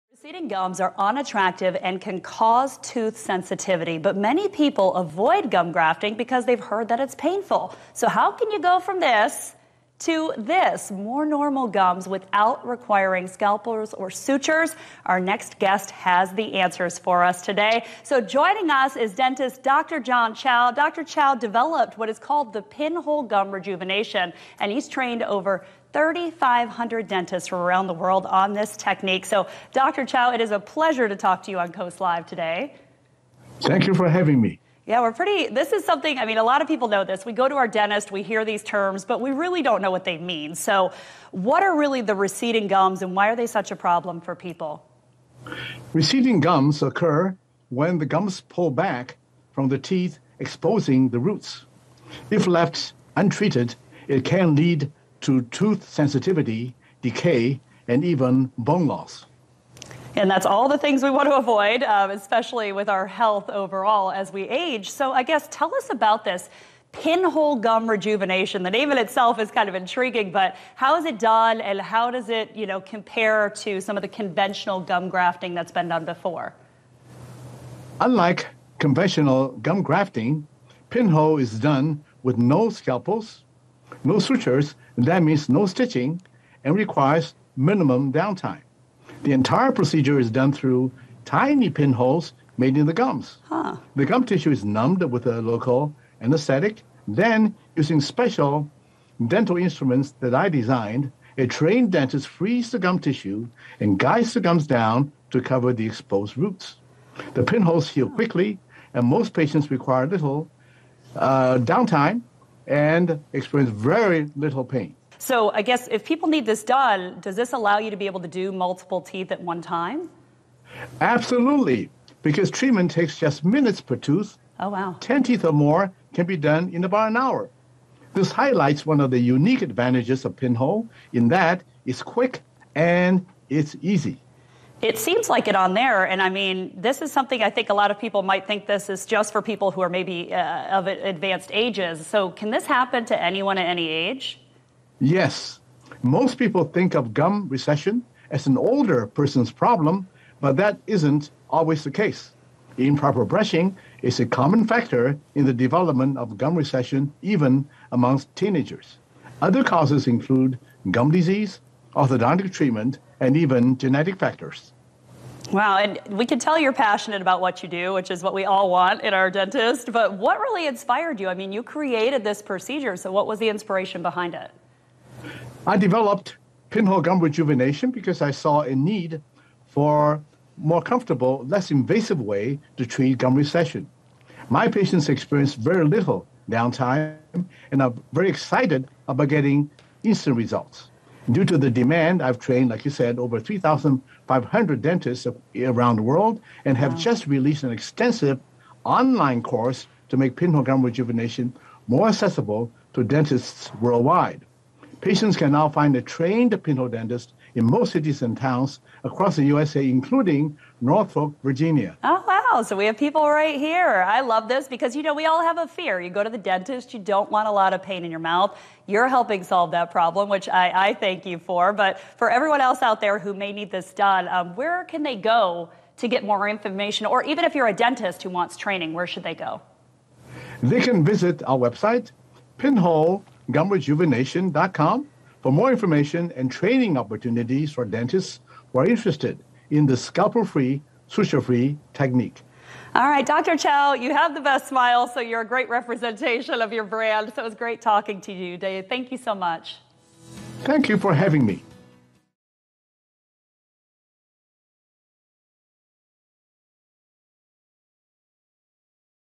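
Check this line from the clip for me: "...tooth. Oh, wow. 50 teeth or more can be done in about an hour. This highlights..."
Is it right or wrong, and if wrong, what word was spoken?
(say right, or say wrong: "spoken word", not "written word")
wrong: "10", not "50".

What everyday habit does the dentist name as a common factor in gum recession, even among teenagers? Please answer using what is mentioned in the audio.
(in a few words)
Improper brushing.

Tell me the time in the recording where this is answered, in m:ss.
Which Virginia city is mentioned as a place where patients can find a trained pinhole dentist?
3:30.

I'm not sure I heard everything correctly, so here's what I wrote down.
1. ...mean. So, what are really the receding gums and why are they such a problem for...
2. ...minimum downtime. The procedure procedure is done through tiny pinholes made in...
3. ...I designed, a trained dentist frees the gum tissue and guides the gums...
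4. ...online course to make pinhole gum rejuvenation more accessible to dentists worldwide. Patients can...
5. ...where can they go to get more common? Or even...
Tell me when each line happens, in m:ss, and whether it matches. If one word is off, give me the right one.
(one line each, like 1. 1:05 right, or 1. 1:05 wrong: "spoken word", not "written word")
1. 0:40 right
2. 1:27 wrong: "entire", not "procedure"
3. 1:40 right
4. 3:18 right
5. 3:44 wrong: "information", not "common".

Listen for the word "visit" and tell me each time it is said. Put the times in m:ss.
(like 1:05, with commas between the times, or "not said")
3:51.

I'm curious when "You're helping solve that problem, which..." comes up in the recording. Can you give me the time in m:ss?
3:38.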